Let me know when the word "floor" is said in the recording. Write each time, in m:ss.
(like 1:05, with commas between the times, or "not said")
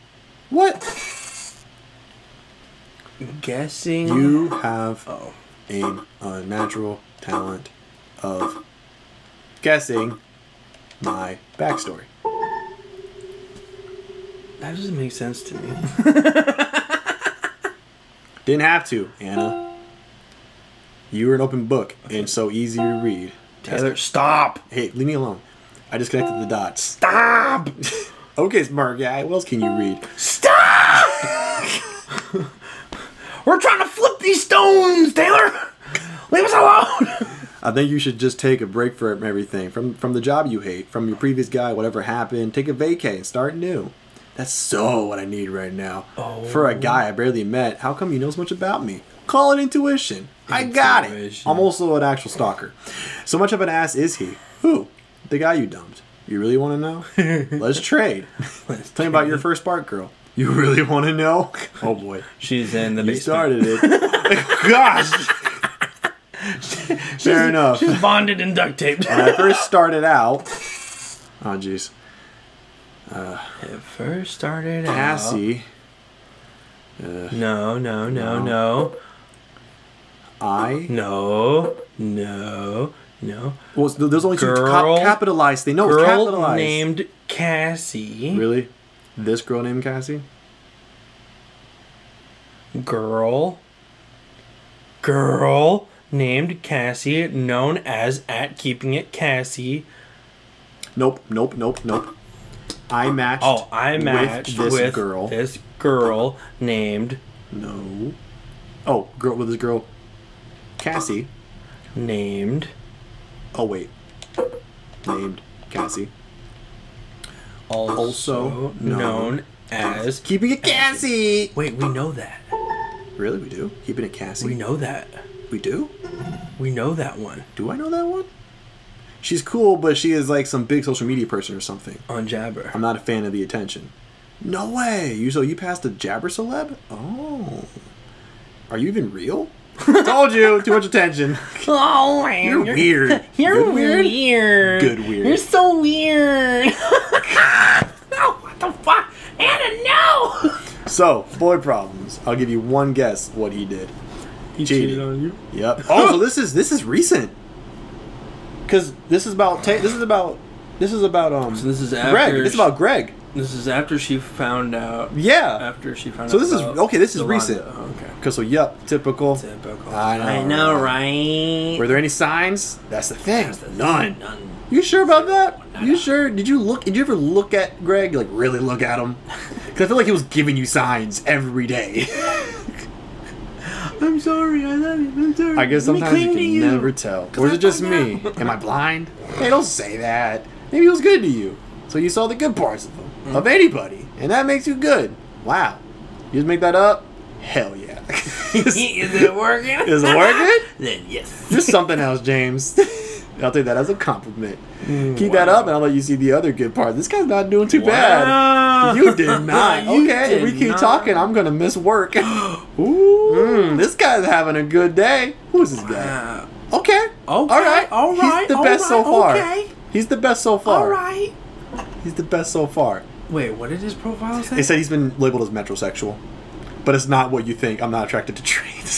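not said.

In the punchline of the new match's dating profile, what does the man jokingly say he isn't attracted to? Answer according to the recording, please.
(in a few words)
trains.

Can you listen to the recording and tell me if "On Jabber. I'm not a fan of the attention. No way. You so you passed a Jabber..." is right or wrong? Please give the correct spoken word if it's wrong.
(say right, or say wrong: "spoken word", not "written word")
right.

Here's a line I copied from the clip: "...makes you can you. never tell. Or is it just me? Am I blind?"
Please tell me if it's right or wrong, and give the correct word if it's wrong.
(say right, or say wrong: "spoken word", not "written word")
wrong: "sometimes", not "makes".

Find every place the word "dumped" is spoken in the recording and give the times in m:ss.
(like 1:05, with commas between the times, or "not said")
0:55.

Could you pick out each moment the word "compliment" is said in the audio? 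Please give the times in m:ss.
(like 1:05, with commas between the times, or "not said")
3:23.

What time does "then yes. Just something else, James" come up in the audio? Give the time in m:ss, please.
3:20.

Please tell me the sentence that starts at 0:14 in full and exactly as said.
That doesn't make sense to me.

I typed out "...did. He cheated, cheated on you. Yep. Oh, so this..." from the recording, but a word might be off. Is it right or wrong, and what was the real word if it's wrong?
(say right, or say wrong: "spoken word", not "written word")
right.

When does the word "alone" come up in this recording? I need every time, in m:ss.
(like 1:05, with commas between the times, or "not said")
0:25, 0:36.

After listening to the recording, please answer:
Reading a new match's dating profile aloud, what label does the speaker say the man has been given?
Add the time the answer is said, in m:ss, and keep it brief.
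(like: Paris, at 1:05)
metrosexual, at 3:45.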